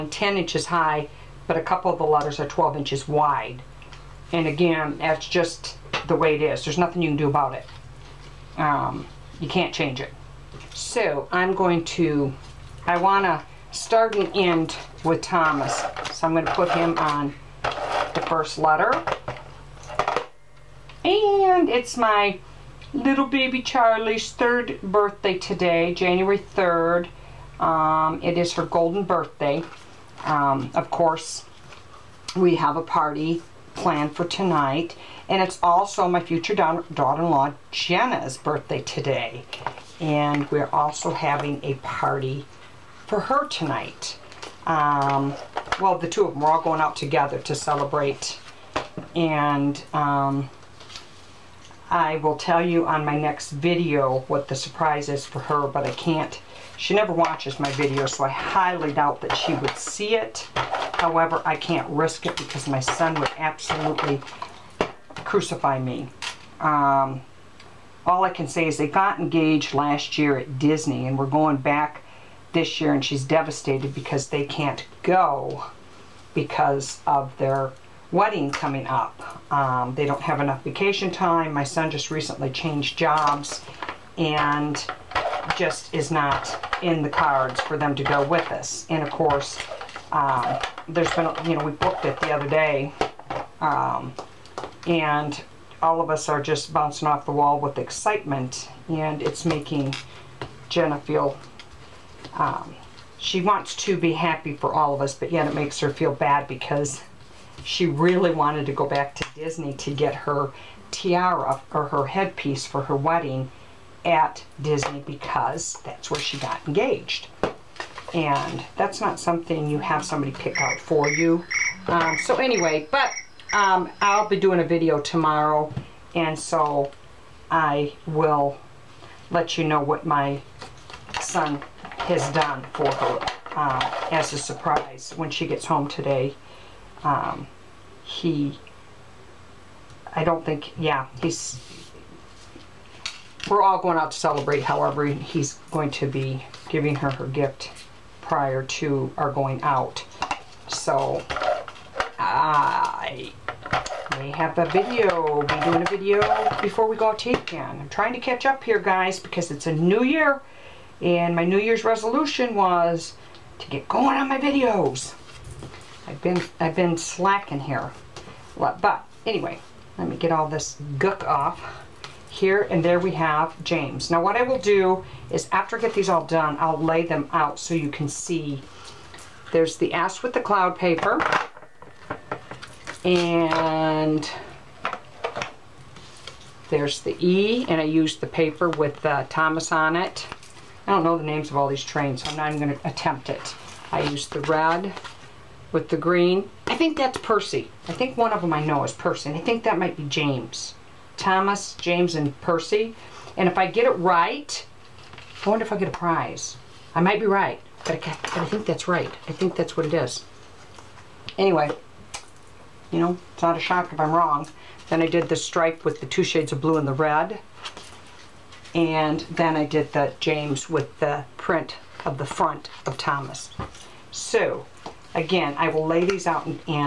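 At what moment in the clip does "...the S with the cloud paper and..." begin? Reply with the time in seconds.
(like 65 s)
179 s.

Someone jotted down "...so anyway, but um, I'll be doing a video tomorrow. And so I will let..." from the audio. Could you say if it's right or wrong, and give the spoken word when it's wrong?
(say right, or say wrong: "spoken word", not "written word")
right.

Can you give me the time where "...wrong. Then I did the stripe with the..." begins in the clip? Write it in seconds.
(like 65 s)
214 s.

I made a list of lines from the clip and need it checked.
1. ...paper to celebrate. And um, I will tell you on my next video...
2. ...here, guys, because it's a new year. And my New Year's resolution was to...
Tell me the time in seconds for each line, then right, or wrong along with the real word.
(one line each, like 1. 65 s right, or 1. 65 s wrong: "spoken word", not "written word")
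1. 46 s wrong: "together", not "paper"
2. 158 s right.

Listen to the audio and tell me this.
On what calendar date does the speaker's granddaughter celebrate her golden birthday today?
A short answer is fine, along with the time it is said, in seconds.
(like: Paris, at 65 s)
January 3, at 25 s.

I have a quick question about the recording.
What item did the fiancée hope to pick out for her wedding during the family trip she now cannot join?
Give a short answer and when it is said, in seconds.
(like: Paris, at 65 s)
Tiara, at 110 s.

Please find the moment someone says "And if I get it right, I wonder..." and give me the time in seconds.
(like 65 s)
203 s.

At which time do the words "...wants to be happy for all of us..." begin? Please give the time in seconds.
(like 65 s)
103 s.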